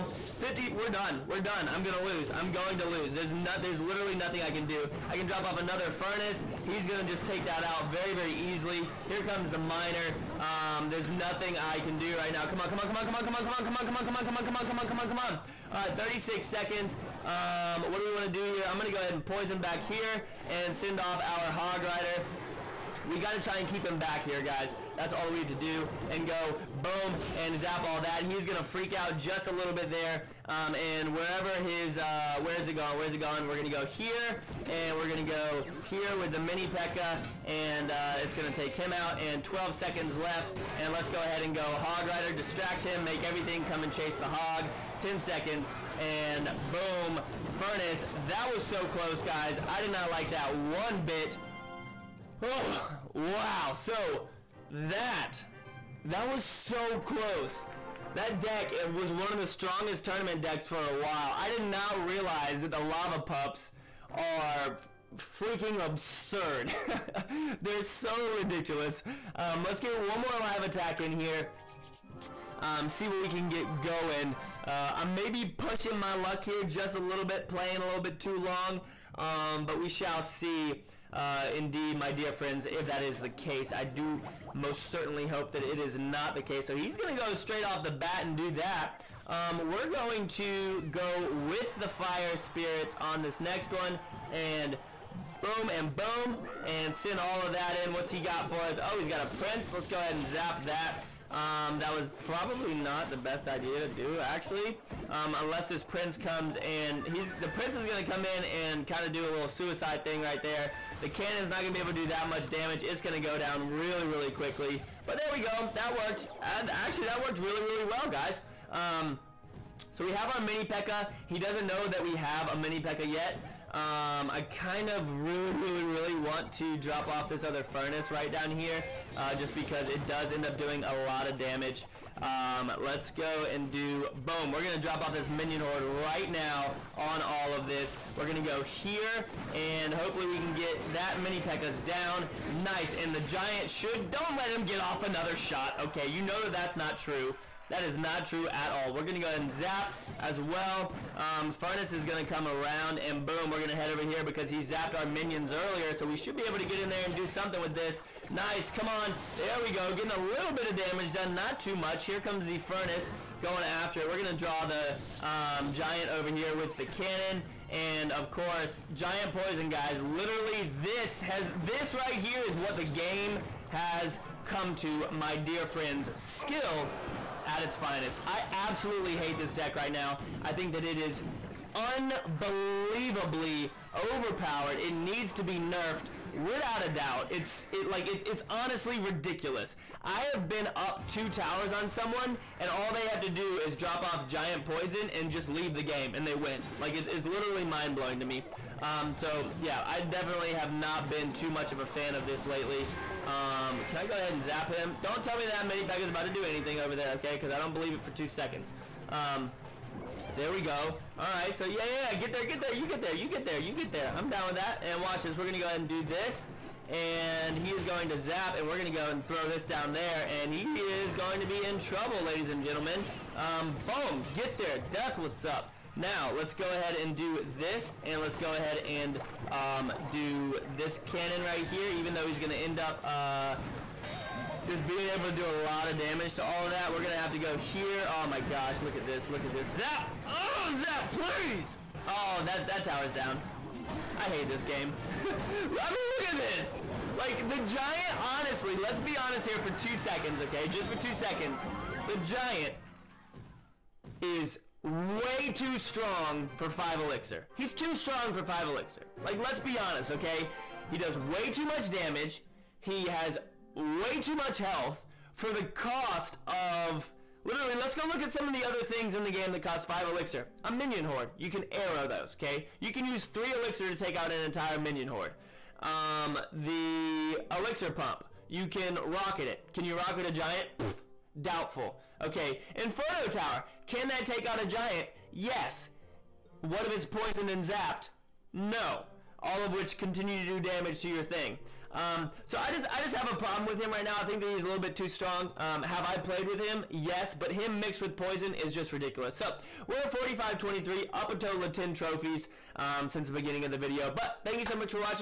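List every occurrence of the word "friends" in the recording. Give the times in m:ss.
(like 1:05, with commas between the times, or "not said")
1:22, 2:55.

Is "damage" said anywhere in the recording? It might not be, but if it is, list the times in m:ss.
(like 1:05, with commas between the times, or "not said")
1:52, 2:11, 2:40, 3:55, 4:21, 4:50.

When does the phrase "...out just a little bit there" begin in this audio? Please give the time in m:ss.
0:28.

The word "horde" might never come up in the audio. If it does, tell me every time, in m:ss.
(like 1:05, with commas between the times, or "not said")
2:15, 4:31, 4:35.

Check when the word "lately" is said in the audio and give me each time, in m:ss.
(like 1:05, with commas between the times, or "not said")
3:22.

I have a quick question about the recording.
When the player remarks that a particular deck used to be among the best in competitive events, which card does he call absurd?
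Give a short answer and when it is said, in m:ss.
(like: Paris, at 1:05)
Lava Pups, at 1:02.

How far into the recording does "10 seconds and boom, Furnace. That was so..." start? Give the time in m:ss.
0:45.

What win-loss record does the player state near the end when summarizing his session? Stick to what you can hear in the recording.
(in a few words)
45-23.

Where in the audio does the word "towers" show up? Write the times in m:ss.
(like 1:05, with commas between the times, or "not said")
3:11, 4:02, 4:43.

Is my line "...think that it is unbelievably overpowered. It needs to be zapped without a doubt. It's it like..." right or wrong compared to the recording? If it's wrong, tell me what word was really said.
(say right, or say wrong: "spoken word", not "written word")
wrong: "nerfed", not "zapped".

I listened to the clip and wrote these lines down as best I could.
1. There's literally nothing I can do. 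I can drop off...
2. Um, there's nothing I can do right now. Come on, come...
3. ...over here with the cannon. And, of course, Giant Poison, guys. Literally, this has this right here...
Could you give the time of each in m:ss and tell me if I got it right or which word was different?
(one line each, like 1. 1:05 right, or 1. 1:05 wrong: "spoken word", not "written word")
1. 0:03 right
2. 0:10 right
3. 2:46 right.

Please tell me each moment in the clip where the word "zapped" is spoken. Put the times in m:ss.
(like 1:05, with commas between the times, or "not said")
2:34, 4:47.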